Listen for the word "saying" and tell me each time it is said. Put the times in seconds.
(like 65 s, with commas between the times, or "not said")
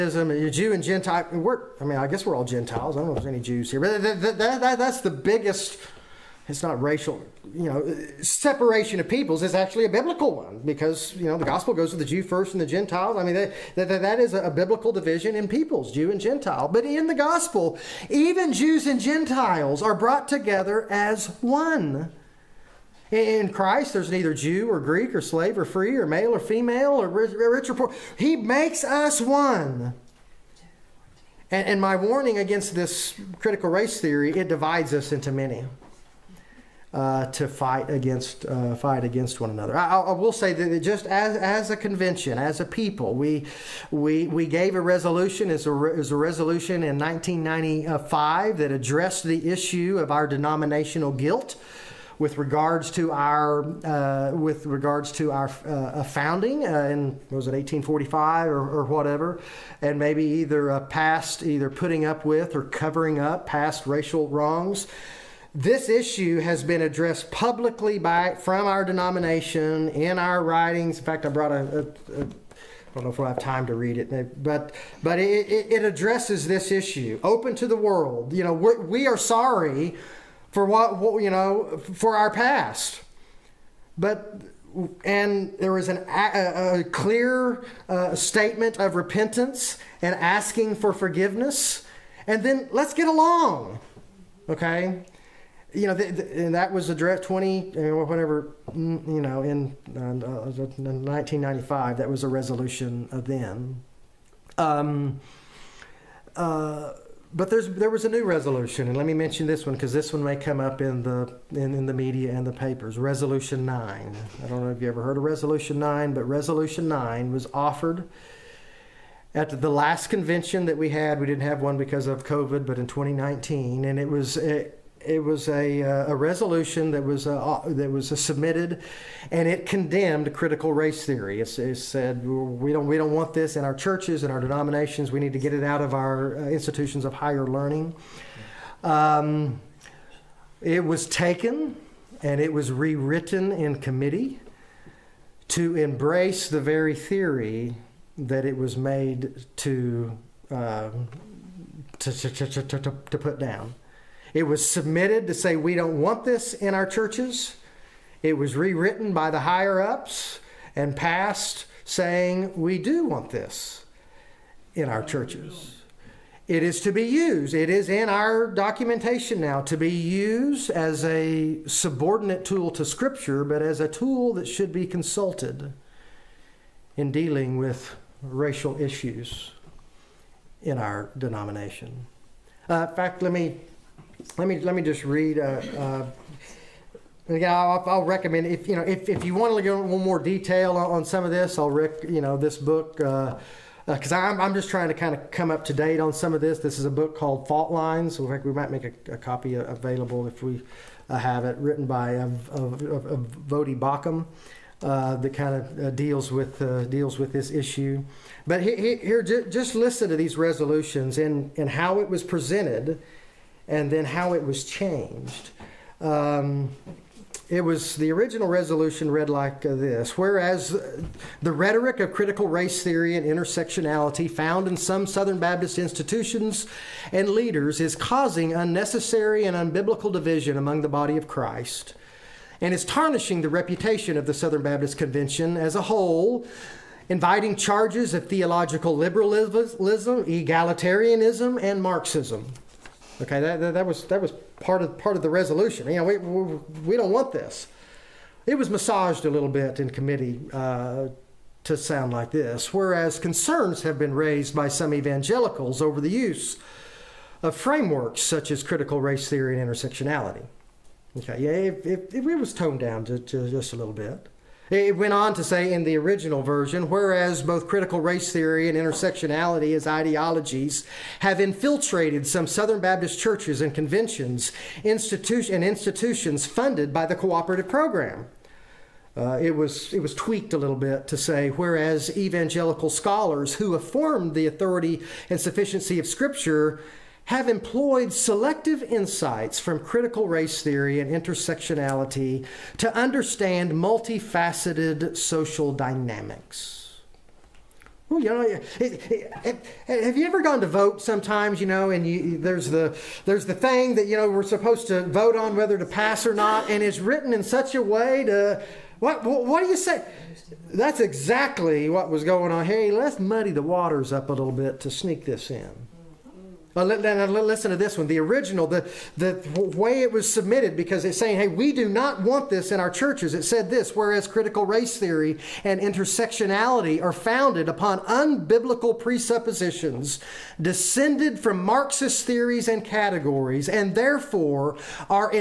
161 s, 321 s.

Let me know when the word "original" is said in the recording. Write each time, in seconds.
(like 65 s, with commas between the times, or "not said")
218 s, 265 s, 318 s.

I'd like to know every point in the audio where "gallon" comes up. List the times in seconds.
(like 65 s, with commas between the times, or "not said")
not said.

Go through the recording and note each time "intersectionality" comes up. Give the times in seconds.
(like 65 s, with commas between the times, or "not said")
223 s, 259 s, 268 s, 291 s, 325 s.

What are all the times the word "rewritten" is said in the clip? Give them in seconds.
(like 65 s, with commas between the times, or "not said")
142 s, 158 s.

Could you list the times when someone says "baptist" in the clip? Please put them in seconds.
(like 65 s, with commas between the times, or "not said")
225 s, 234 s, 272 s.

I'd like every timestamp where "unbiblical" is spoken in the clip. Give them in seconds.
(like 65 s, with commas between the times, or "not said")
229 s, 328 s.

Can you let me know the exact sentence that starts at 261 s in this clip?
Okay, yeah, it, it, it was toned down to, to just a little bit.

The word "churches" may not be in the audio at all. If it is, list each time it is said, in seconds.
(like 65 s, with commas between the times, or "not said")
133 s, 156 s, 165 s, 273 s, 322 s.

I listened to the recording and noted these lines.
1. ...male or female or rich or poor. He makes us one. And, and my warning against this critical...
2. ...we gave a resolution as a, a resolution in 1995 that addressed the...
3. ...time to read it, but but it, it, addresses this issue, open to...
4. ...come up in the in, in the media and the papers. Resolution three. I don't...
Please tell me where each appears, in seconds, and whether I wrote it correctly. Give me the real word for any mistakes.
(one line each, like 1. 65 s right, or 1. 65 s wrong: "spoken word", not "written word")
1. 26 s right
2. 44 s right
3. 73 s right
4. 110 s wrong: "nine", not "three".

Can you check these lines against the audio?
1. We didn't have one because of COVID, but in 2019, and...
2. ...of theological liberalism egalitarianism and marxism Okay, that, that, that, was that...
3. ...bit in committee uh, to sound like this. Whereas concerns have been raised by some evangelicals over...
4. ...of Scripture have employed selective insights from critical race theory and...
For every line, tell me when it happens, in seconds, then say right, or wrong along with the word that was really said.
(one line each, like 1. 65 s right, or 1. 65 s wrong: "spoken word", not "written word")
1. 121 s right
2. 238 s right
3. 249 s right
4. 285 s right.